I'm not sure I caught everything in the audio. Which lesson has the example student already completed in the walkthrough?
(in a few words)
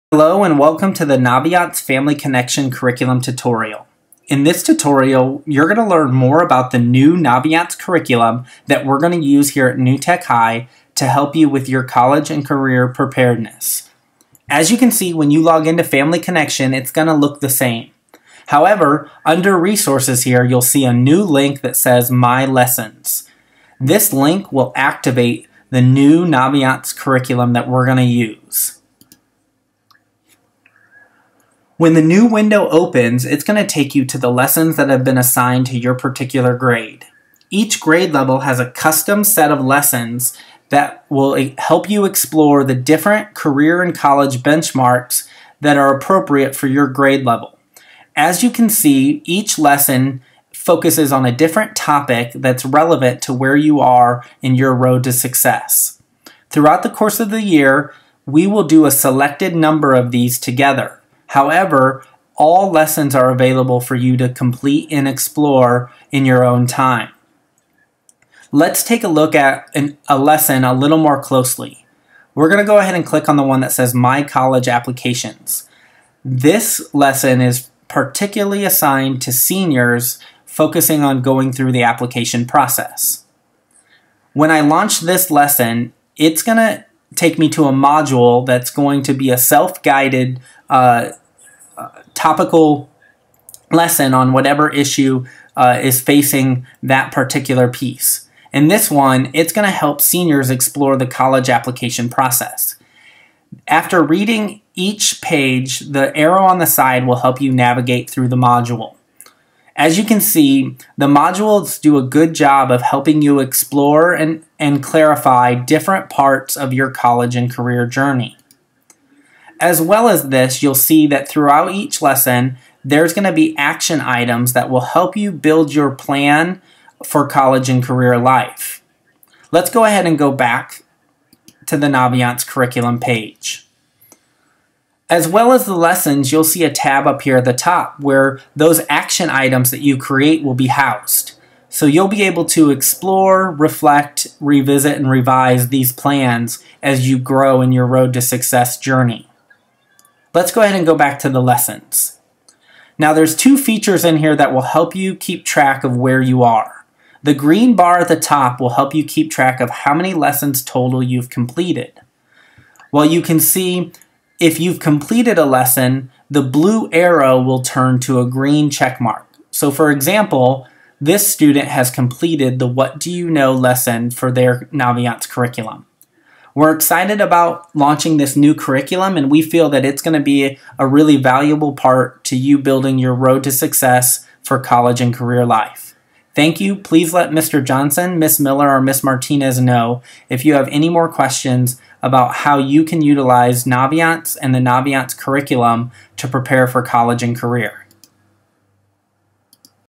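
What Do You Know.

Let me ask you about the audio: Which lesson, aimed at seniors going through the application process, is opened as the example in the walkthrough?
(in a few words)
My College Applications.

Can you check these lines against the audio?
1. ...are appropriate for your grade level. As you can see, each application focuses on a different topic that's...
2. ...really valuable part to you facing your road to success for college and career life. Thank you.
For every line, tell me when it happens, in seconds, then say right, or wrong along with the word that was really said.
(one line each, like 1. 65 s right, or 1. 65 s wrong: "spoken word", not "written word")
1. 45 s wrong: "lesson", not "application"
2. 180 s wrong: "building", not "facing".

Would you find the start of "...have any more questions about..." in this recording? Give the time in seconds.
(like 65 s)
190 s.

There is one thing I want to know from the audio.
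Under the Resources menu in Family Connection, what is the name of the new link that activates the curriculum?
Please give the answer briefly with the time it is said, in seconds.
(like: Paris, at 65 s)
My Lessons, at 22 s.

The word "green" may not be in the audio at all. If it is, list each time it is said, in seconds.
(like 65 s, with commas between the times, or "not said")
157 s, 168 s.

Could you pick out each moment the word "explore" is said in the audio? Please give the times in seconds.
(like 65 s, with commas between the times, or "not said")
42 s, 65 s, 100 s, 113 s, 142 s.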